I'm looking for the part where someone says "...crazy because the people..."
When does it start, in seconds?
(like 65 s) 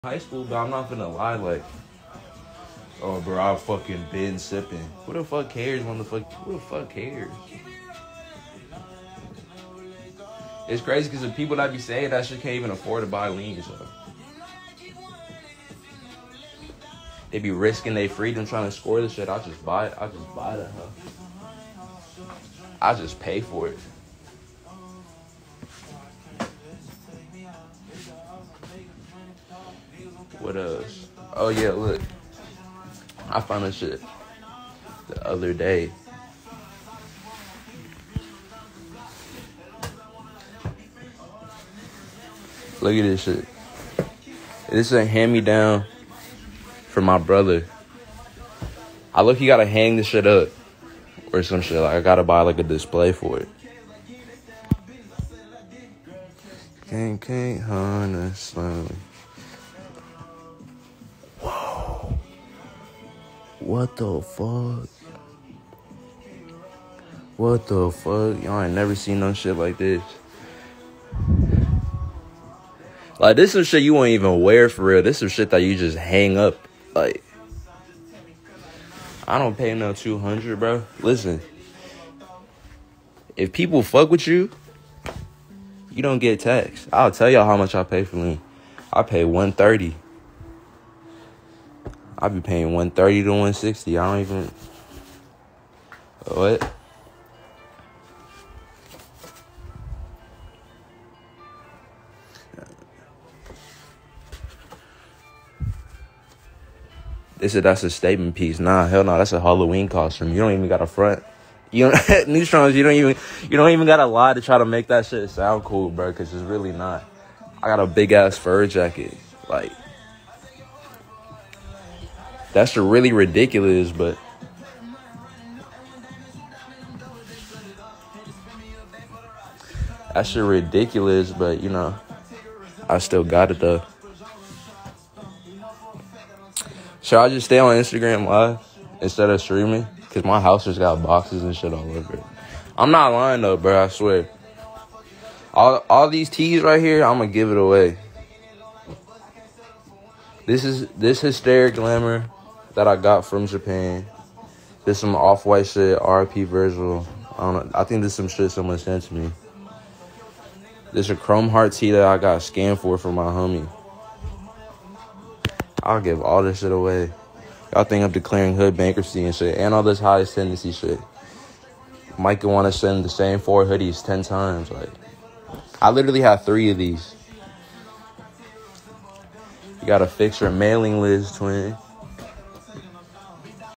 10 s.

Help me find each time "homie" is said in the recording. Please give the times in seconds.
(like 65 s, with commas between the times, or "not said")
163 s.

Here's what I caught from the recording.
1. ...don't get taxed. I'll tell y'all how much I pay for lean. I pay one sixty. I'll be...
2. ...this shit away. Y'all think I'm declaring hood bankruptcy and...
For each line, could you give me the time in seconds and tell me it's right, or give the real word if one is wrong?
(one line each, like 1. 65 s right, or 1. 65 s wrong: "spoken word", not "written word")
1. 86 s wrong: "thirty", not "sixty"
2. 166 s right.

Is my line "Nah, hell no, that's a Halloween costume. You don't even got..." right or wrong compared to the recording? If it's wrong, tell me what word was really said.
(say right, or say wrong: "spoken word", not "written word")
right.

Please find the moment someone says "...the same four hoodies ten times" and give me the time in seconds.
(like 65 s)
173 s.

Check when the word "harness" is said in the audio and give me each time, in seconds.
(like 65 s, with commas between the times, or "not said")
57 s.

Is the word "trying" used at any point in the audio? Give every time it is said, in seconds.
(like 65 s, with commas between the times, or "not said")
18 s.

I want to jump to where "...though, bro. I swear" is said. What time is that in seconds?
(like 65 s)
143 s.